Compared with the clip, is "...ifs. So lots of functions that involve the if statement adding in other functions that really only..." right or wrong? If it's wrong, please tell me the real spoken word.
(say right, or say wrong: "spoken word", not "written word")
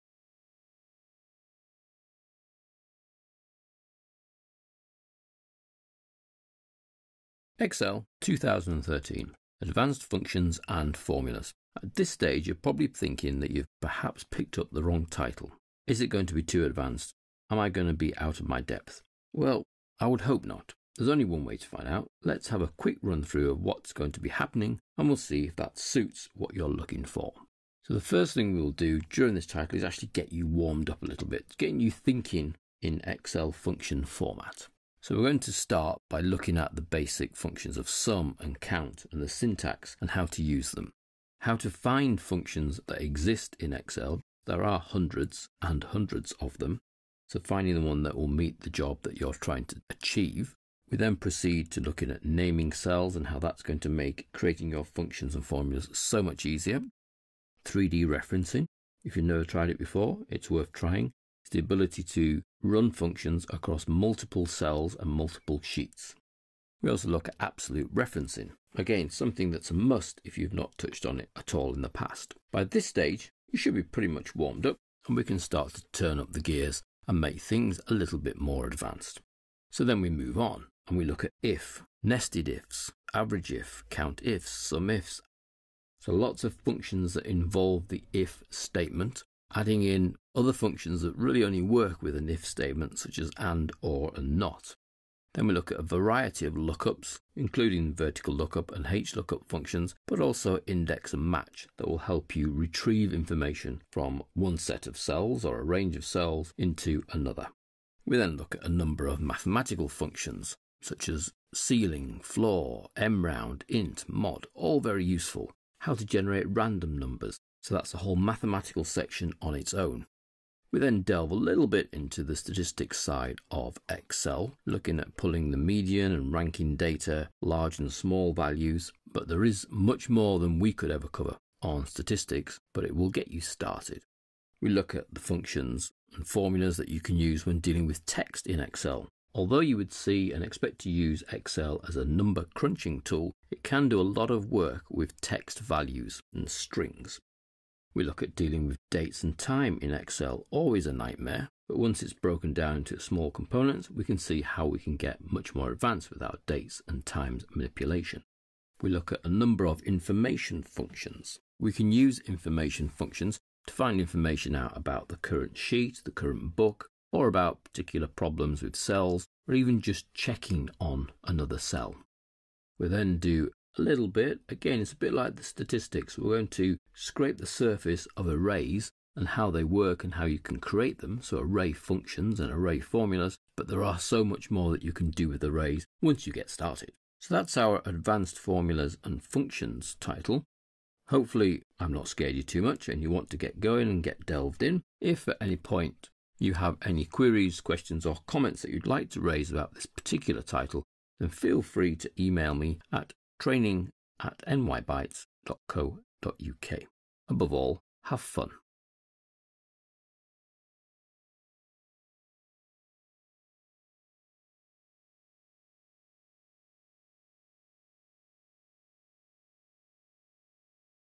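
right.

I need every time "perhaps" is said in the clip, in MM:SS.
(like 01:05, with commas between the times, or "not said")
00:13.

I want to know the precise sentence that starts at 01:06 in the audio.
We also look at absolute referencing, again, something that's a must if you've not touched on it at all in the past.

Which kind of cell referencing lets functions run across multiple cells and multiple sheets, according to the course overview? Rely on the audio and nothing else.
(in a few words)
3D referencing.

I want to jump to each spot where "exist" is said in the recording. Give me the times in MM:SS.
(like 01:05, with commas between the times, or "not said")
00:43.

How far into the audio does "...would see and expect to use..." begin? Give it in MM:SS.
02:19.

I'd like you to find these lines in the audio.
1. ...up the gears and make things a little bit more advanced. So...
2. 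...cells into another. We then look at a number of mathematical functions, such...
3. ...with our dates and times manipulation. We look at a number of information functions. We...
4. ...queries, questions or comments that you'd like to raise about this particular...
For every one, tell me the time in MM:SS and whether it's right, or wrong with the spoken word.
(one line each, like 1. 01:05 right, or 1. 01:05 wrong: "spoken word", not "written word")
1. 01:16 right
2. 01:46 right
3. 02:36 right
4. 03:17 right.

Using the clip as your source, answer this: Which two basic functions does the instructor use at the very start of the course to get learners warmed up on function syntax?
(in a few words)
sum and count.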